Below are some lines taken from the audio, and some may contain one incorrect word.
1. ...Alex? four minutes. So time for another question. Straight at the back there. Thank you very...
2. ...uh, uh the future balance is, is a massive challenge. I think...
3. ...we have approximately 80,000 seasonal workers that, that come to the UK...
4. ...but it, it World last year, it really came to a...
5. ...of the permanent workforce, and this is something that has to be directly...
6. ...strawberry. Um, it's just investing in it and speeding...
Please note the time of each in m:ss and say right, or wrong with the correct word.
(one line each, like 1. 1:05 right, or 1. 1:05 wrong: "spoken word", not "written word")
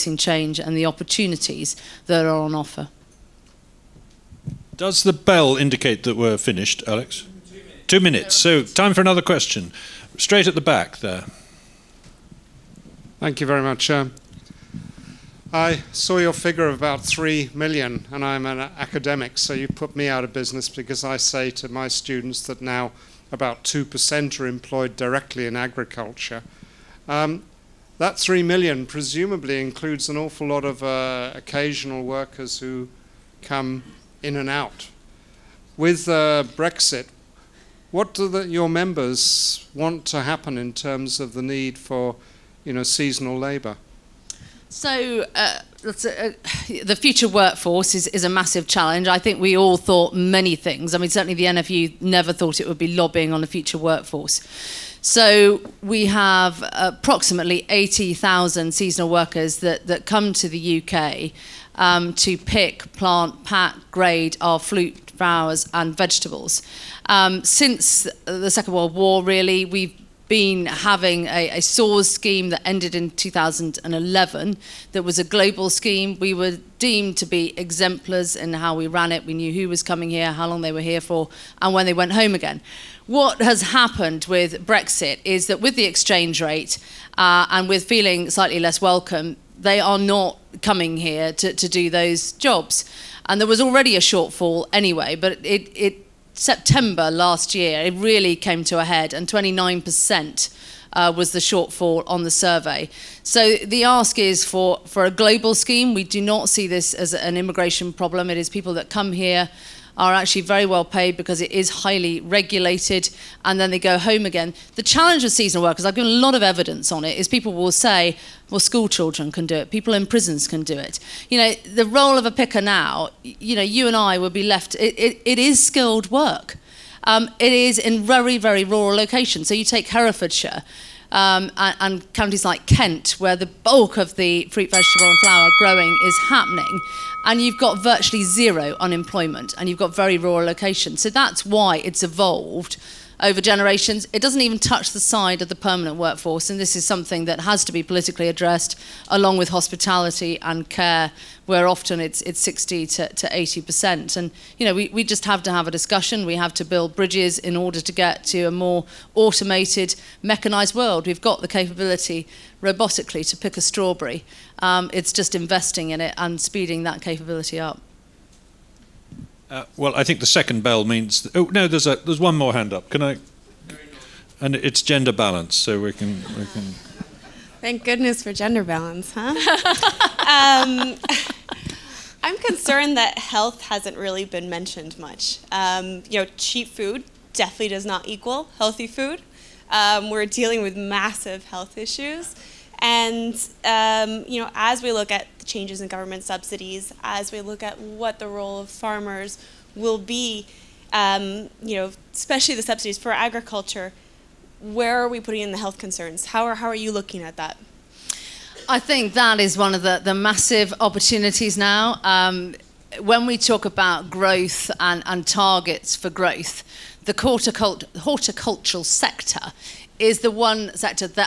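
1. 0:06 wrong: "two", not "four"
2. 0:45 wrong: "workforce", not "balance"
3. 0:55 right
4. 1:35 wrong: "September", not "World"
5. 2:25 wrong: "politically", not "directly"
6. 2:43 right.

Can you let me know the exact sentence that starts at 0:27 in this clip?
Um, that 3 million presumably includes an awful lot of uh, occasional workers who come in and out.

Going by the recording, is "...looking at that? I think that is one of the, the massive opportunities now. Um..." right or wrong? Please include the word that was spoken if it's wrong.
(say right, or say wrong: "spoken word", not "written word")
right.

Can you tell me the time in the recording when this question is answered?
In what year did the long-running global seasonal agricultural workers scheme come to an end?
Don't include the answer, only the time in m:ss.
1:13.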